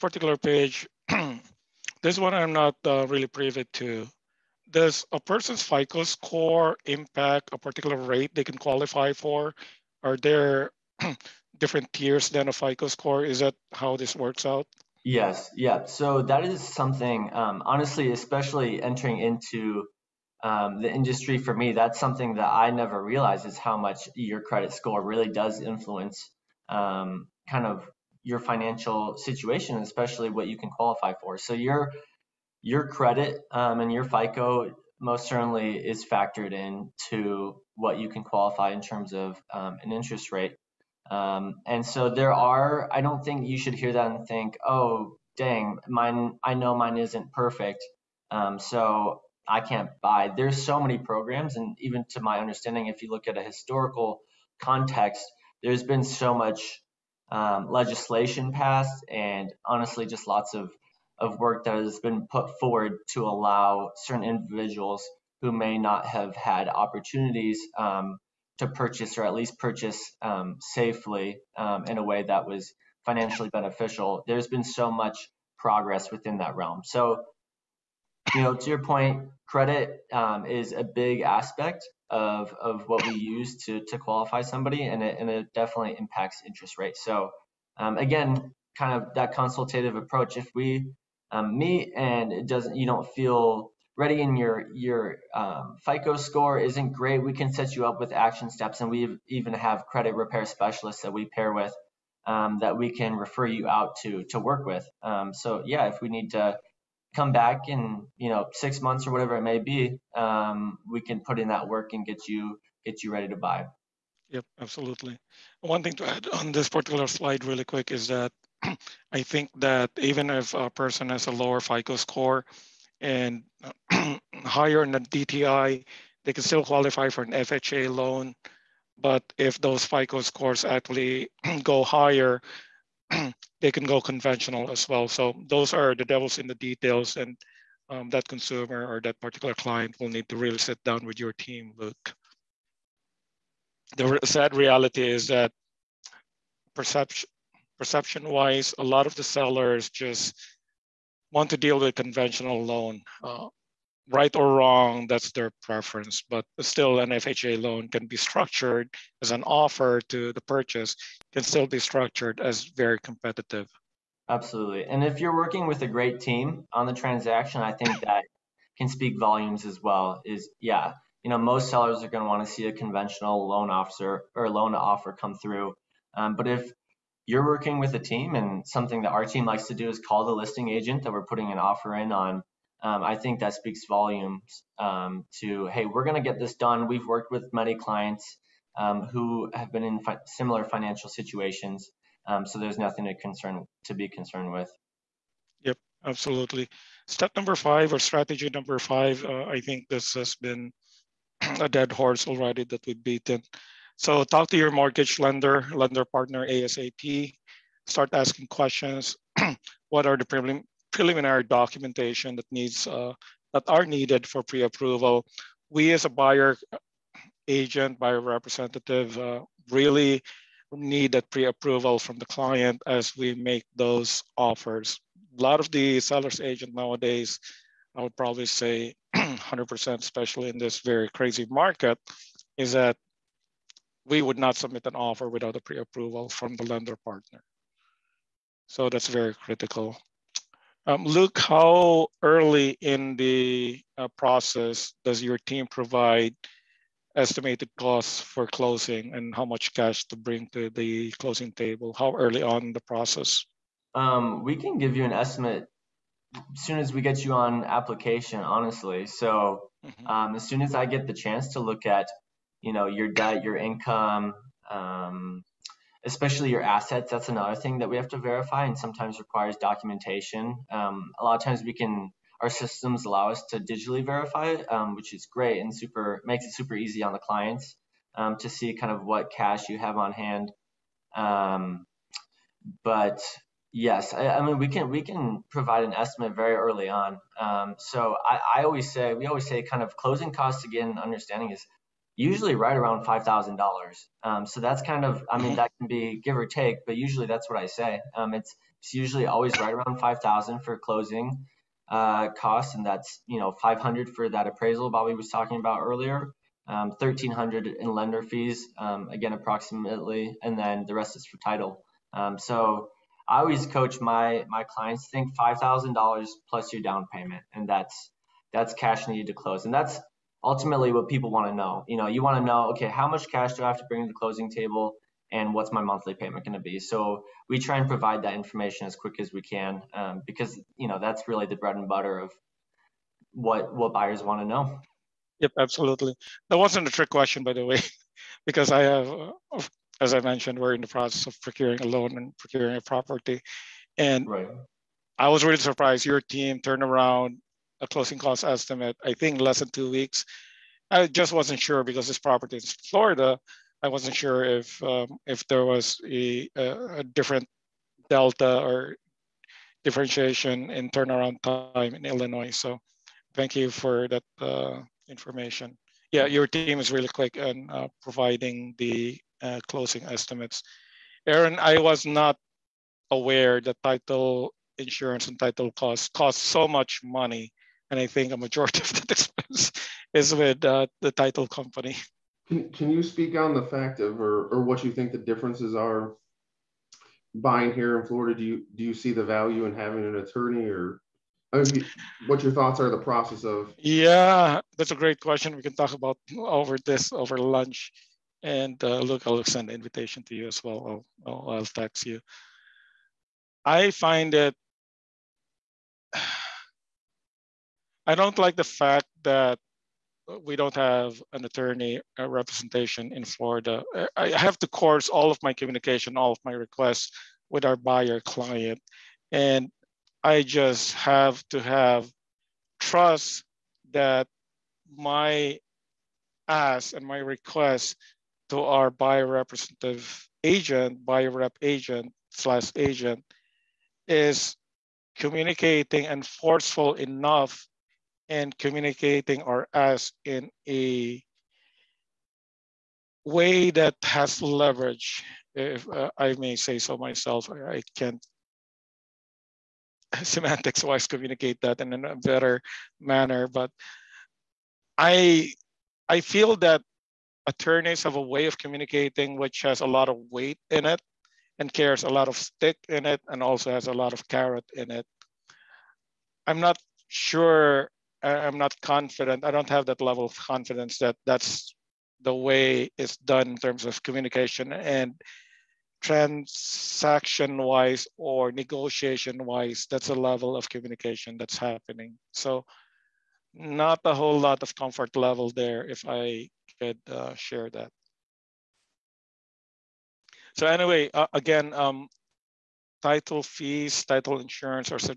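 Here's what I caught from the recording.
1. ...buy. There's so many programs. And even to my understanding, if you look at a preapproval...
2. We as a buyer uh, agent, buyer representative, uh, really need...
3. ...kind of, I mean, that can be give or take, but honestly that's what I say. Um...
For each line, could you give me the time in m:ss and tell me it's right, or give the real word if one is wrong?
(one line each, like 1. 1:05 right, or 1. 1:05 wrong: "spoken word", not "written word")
1. 0:50 wrong: "historical", not "preapproval"
2. 3:35 right
3. 4:54 wrong: "usually", not "honestly".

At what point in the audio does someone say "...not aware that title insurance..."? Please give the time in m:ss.
6:12.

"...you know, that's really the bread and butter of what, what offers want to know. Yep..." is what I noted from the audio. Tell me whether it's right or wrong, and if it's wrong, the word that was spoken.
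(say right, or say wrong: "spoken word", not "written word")
wrong: "buyers", not "offers".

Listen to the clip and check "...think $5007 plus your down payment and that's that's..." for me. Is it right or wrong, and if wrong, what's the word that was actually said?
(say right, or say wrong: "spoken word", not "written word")
wrong: "5000", not "5007".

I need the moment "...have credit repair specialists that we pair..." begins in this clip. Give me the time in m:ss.
1:39.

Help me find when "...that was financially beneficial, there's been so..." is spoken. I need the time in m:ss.
1:12.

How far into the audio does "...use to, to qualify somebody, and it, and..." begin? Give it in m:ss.
1:23.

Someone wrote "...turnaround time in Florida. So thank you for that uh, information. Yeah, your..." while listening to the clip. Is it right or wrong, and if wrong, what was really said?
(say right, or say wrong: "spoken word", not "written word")
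wrong: "Illinois", not "Florida".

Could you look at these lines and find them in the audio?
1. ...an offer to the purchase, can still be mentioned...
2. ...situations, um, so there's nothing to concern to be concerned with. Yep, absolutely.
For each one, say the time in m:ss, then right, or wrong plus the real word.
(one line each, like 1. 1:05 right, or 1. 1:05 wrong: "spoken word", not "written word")
1. 2:39 wrong: "structured", not "mentioned"
2. 3:11 right.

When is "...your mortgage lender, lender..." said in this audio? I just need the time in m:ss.
3:24.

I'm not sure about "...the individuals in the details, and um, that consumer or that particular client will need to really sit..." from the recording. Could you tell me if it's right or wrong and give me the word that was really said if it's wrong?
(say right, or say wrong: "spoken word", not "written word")
wrong: "devils", not "individuals".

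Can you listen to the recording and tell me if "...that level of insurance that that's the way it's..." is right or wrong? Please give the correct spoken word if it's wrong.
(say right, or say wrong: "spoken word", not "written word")
wrong: "confidence", not "insurance".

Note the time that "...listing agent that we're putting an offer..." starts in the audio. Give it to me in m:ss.
3:00.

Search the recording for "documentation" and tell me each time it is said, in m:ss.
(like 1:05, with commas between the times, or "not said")
3:31, 4:29.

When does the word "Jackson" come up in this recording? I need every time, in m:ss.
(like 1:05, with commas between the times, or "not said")
not said.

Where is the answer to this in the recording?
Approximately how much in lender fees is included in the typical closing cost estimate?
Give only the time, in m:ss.
5:06.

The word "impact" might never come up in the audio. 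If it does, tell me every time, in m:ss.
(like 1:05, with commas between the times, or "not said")
0:06, 1:25.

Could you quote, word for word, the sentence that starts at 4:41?
Um, but yes, I, I, mean we can we can provide an estimate very early on.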